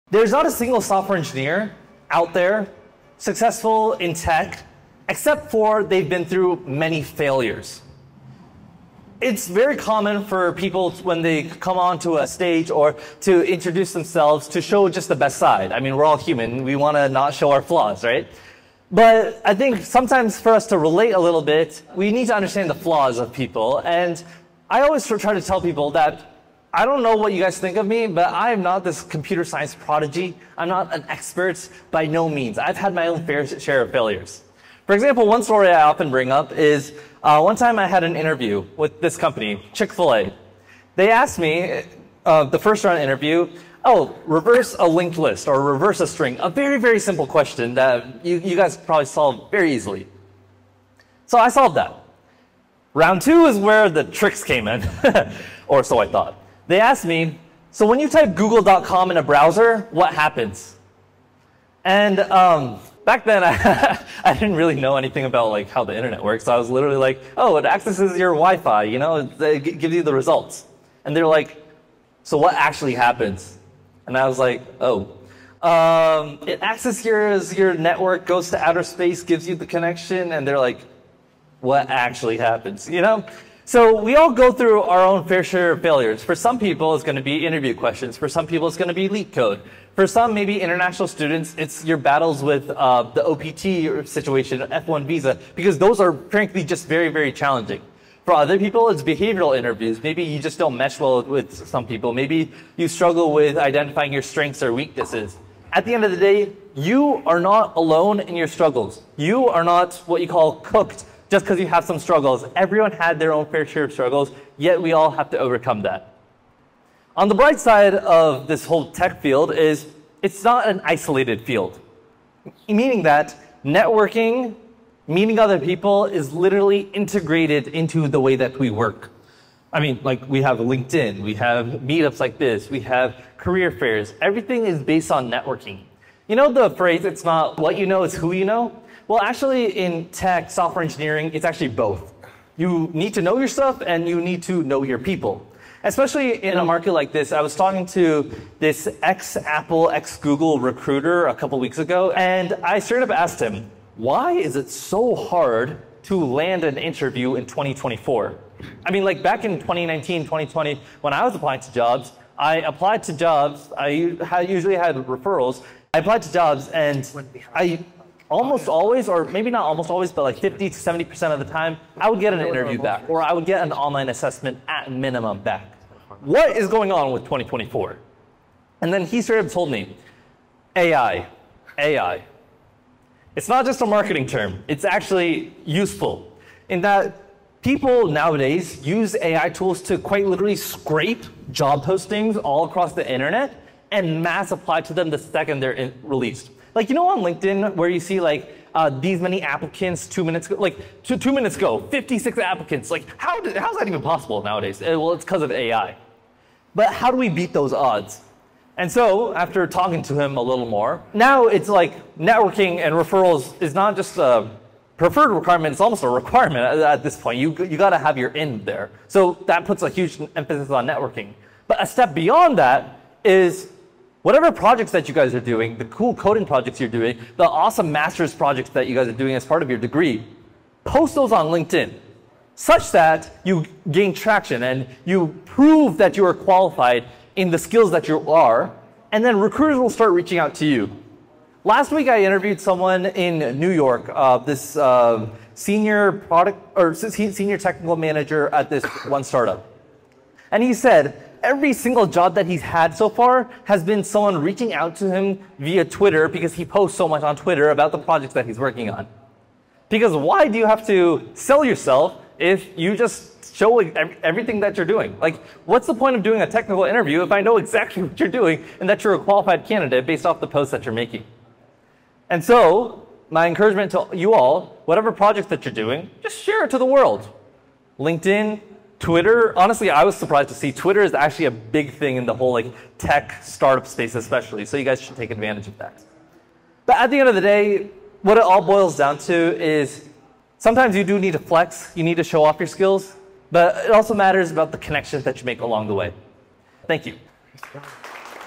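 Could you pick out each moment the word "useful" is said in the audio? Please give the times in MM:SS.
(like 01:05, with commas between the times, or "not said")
03:05.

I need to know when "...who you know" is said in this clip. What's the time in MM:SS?
02:18.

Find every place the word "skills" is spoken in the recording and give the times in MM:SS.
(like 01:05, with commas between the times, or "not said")
03:57, 04:52.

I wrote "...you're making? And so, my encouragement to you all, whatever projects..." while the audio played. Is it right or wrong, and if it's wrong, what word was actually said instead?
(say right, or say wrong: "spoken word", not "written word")
right.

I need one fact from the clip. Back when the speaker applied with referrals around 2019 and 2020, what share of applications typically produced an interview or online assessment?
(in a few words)
50 to 70%.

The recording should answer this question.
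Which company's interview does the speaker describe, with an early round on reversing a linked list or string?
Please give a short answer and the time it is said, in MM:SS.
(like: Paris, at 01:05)
Chick-fil-A, at 00:39.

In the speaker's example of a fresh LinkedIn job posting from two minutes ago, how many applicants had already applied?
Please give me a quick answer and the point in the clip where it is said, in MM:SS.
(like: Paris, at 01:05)
56, at 03:21.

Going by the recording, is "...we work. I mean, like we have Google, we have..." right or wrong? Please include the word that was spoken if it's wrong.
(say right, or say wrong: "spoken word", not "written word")
wrong: "LinkedIn", not "Google".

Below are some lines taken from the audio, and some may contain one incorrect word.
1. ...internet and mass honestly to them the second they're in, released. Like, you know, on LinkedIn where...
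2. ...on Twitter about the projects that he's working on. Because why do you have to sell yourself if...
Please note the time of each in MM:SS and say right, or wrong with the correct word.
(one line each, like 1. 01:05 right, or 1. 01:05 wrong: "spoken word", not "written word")
1. 03:13 wrong: "apply", not "honestly"
2. 04:17 right.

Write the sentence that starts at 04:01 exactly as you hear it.
Last week, I interviewed someone in New York, uh, this uh, senior product or senior technical manager at this one startup.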